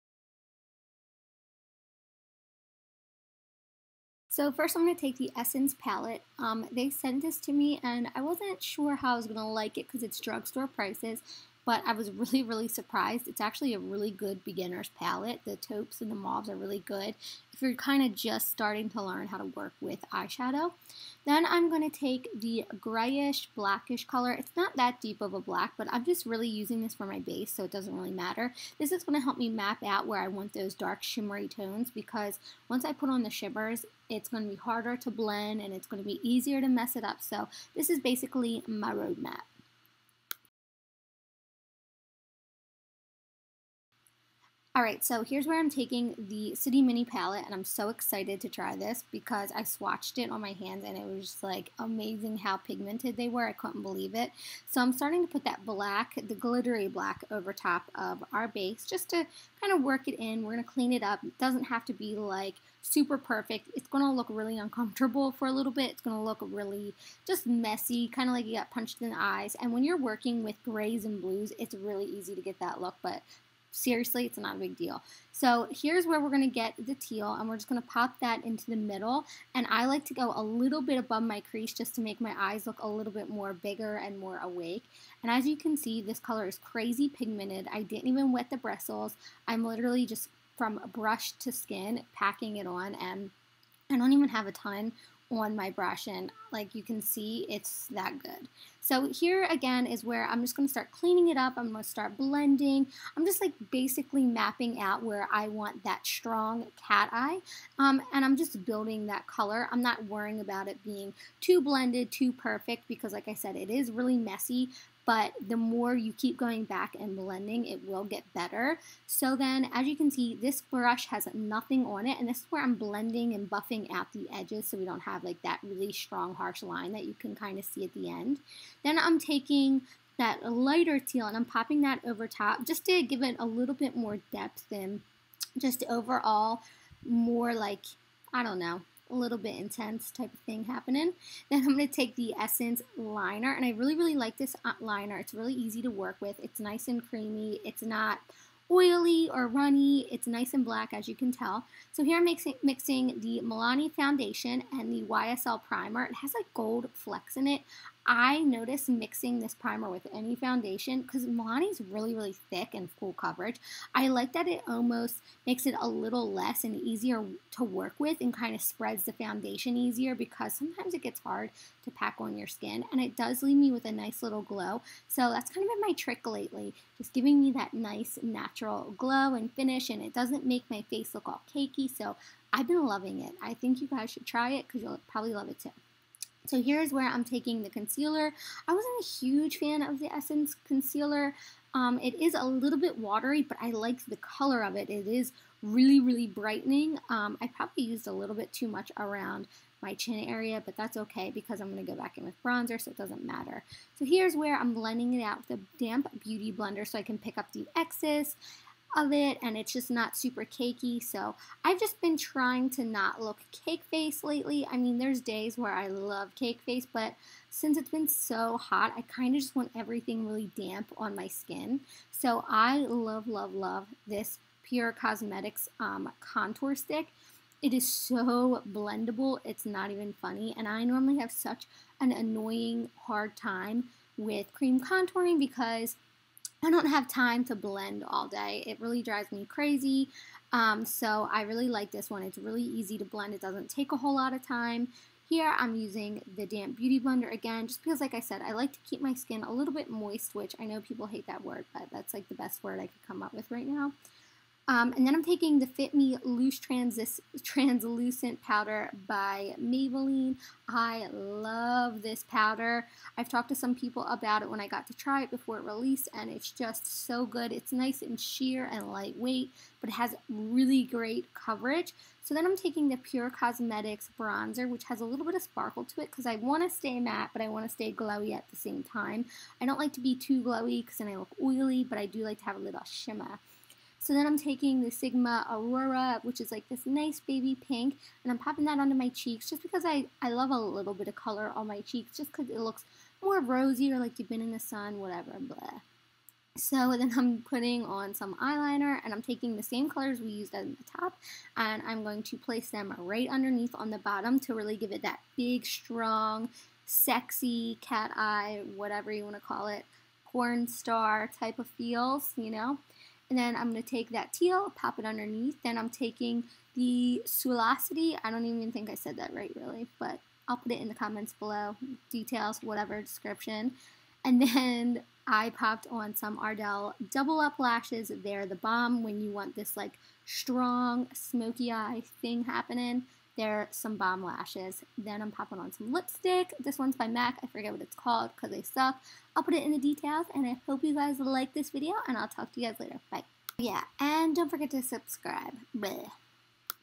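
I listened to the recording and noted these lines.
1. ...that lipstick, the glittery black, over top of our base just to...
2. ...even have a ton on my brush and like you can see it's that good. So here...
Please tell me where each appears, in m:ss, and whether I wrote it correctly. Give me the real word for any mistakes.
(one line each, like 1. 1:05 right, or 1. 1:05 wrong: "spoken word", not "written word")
1. 0:55 wrong: "black", not "lipstick"
2. 1:34 right.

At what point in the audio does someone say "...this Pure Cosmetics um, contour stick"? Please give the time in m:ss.
3:44.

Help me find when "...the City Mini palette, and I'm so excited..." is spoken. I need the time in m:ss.
0:46.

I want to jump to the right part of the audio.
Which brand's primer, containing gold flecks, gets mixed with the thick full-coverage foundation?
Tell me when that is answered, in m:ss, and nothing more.
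2:35.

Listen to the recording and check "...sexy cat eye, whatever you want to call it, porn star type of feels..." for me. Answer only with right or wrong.
right.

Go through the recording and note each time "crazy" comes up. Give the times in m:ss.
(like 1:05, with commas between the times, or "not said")
1:26, 3:59.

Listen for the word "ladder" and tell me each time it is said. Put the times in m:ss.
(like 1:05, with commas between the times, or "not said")
not said.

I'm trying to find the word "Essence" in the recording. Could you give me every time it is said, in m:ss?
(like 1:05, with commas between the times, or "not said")
0:05, 2:22, 3:10.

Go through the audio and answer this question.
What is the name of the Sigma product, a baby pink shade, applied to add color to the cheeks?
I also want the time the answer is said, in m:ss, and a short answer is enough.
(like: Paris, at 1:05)
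Aurora, at 4:44.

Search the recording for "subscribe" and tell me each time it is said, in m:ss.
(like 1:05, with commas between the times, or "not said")
5:44.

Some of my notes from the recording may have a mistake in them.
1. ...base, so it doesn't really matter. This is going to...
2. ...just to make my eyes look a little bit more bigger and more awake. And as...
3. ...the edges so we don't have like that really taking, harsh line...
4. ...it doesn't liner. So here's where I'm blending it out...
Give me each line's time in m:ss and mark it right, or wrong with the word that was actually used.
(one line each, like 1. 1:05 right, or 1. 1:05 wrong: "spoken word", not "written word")
1. 0:27 right
2. 1:21 right
3. 2:04 wrong: "strong", not "taking"
4. 3:22 wrong: "matter", not "liner".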